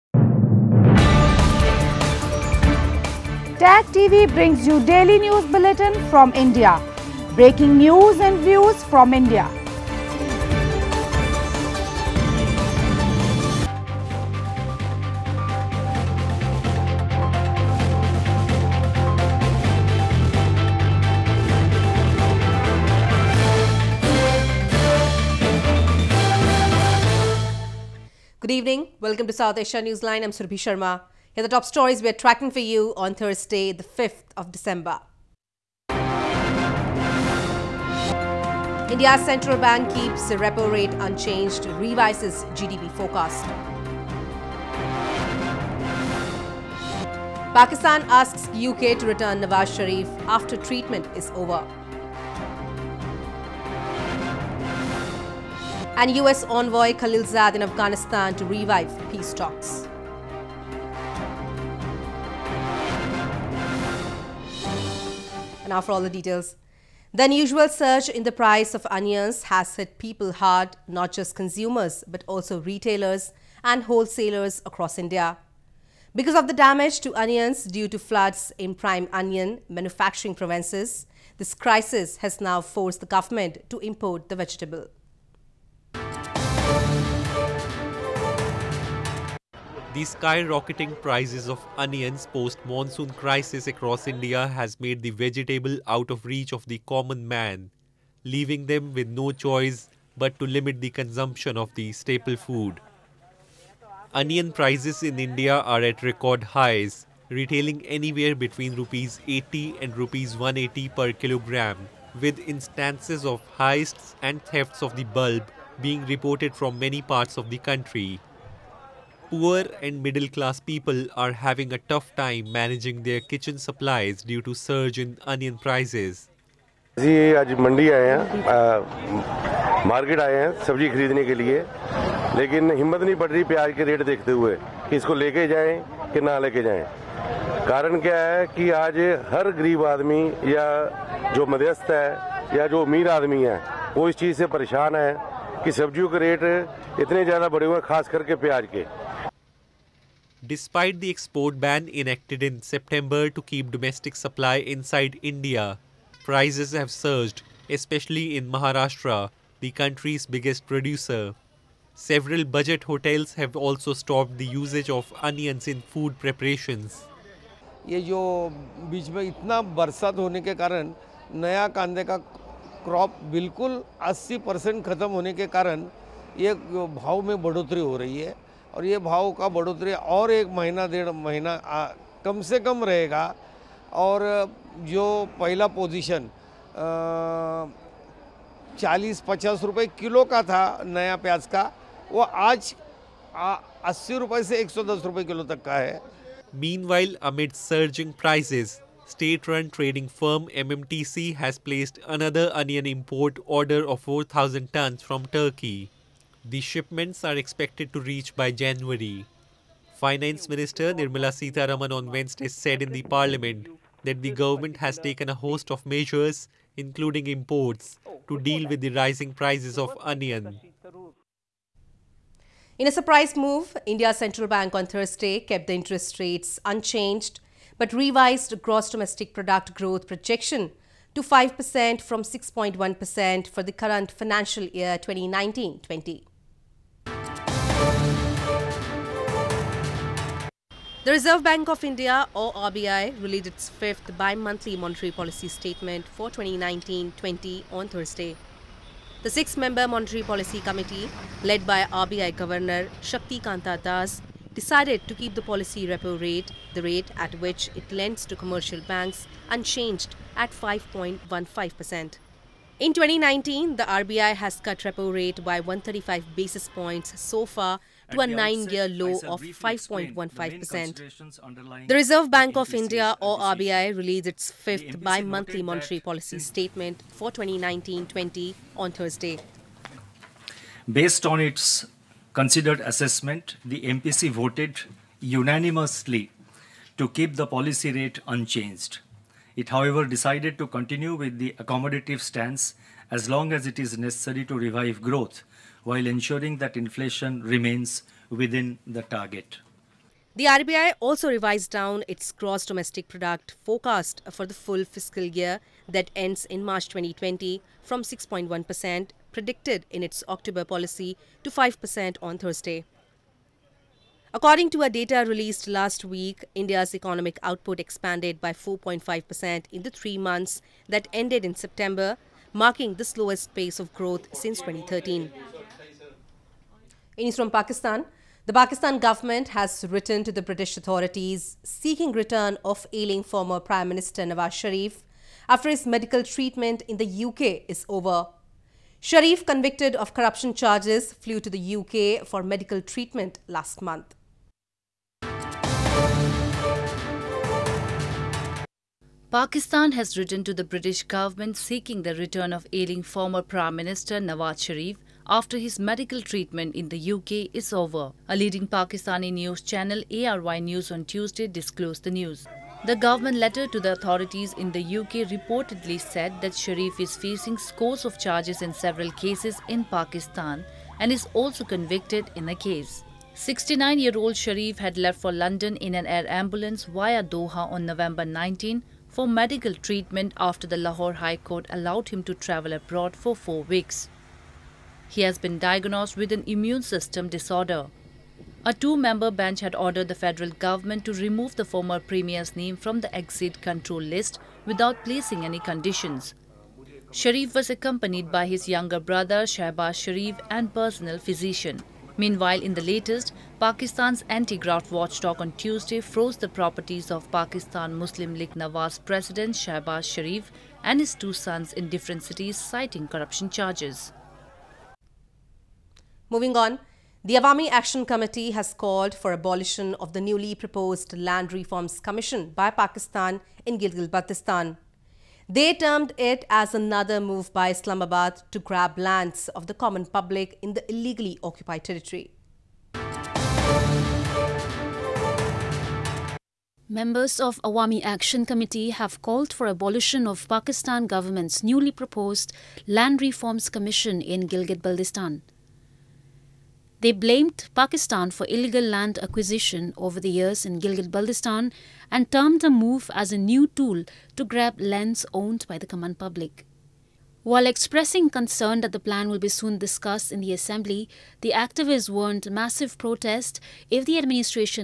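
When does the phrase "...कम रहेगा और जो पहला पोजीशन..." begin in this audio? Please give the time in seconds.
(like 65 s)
182 s.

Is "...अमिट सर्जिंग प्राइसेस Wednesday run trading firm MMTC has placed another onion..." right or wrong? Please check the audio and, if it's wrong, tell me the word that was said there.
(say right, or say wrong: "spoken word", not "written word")
wrong: "State", not "Wednesday".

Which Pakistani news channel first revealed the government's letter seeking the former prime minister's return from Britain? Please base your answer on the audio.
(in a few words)
ARY News.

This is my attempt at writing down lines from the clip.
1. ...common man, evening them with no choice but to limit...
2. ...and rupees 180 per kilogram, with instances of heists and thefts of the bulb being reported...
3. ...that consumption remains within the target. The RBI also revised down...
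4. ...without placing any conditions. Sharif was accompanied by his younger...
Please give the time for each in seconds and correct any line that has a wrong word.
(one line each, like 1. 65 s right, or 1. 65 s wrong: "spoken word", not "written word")
1. 96 s wrong: "leaving", not "evening"
2. 109 s right
3. 296 s wrong: "inflation", not "consumption"
4. 394 s right.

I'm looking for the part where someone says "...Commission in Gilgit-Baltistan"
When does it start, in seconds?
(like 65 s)
443 s.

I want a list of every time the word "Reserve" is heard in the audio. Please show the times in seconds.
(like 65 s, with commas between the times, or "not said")
241 s, 271 s.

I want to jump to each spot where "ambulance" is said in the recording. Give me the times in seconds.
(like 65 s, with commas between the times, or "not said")
376 s.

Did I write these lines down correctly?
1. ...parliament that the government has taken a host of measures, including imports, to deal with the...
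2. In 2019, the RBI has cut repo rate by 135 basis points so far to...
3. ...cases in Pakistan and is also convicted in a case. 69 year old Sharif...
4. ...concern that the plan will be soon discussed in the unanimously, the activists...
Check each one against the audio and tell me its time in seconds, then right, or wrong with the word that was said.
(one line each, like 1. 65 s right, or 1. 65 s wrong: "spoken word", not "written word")
1. 212 s right
2. 262 s right
3. 369 s right
4. 458 s wrong: "assembly", not "unanimously".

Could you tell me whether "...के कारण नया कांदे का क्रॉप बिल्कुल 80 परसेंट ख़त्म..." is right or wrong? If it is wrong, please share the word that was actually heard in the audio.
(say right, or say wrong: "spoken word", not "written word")
right.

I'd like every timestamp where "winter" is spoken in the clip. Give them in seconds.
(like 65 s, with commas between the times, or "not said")
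not said.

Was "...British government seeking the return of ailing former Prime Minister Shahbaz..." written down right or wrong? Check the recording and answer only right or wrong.
wrong.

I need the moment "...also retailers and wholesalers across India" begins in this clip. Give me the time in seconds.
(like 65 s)
72 s.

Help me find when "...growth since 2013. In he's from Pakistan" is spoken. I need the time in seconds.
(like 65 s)
323 s.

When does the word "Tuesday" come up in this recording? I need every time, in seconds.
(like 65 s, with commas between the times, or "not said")
361 s, 405 s.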